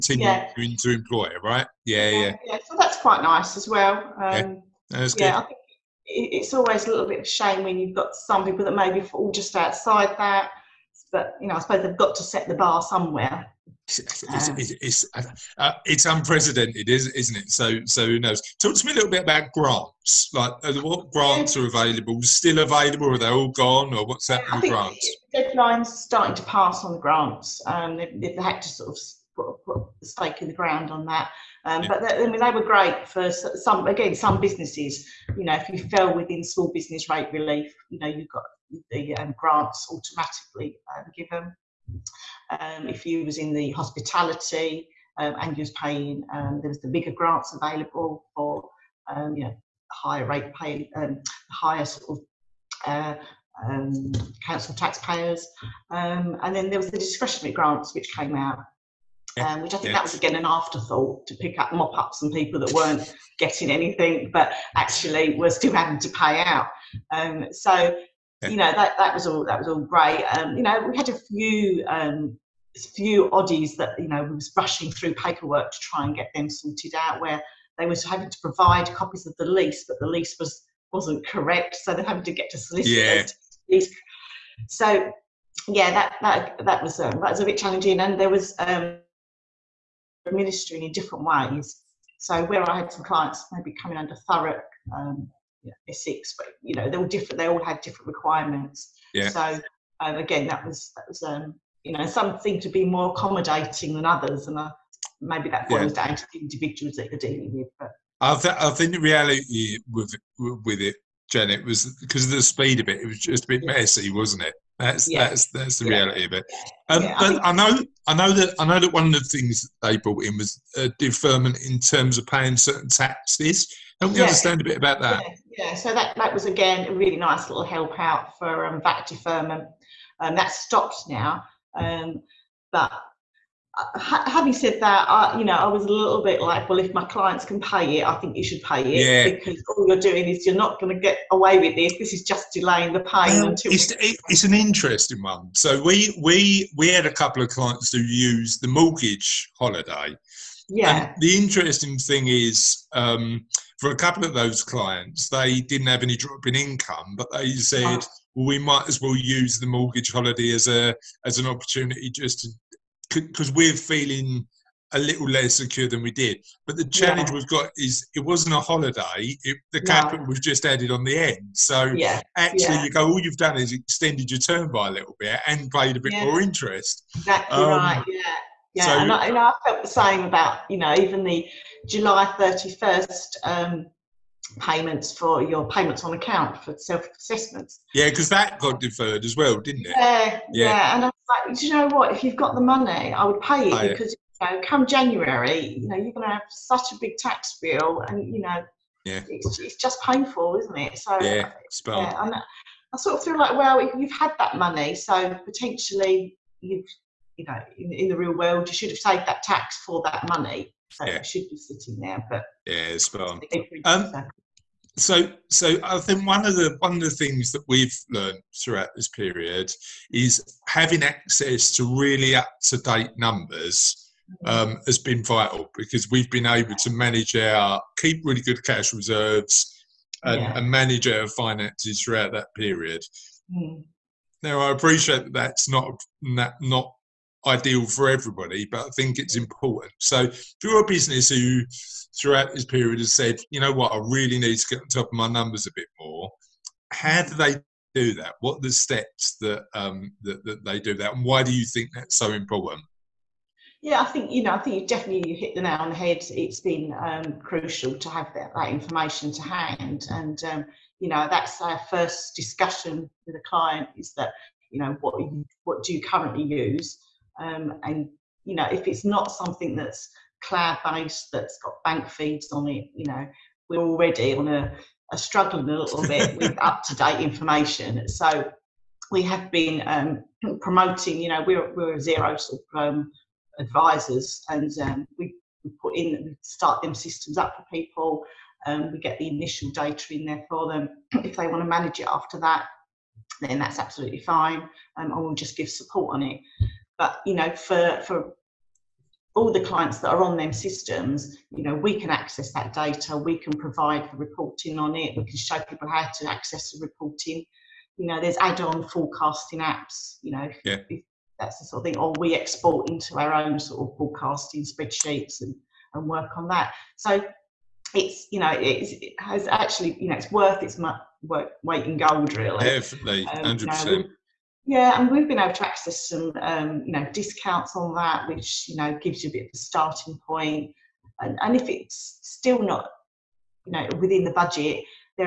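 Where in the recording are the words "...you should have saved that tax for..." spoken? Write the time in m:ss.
3:28.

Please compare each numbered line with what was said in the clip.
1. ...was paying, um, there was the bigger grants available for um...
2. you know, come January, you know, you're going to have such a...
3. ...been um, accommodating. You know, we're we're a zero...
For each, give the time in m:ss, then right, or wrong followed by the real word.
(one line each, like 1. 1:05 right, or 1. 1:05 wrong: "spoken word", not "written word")
1. 0:45 right
2. 3:14 right
3. 4:39 wrong: "promoting", not "accommodating".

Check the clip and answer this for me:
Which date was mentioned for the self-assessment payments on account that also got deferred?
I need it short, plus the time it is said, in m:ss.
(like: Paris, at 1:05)
July 31, at 3:01.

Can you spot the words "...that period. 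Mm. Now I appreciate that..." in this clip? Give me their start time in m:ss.
3:52.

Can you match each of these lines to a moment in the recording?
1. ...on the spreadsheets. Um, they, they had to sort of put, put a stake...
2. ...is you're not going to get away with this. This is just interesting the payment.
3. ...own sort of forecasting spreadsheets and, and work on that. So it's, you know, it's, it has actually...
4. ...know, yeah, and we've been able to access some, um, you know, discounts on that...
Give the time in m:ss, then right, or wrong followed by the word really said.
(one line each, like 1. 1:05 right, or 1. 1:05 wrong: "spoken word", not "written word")
1. 0:26 wrong: "grants", not "spreadsheets"
2. 2:20 wrong: "delaying", not "interesting"
3. 5:13 right
4. 5:24 right.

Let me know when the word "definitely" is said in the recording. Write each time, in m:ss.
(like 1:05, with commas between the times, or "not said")
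4:14, 5:22.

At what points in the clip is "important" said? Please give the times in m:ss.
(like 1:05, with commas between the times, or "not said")
3:59, 4:12.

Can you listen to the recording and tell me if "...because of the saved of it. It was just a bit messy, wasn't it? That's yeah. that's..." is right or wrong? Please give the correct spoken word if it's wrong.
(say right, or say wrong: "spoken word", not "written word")
wrong: "speed", not "saved".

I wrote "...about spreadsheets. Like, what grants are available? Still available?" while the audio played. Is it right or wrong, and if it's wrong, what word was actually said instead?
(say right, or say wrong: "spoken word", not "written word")
wrong: "grants", not "spreadsheets".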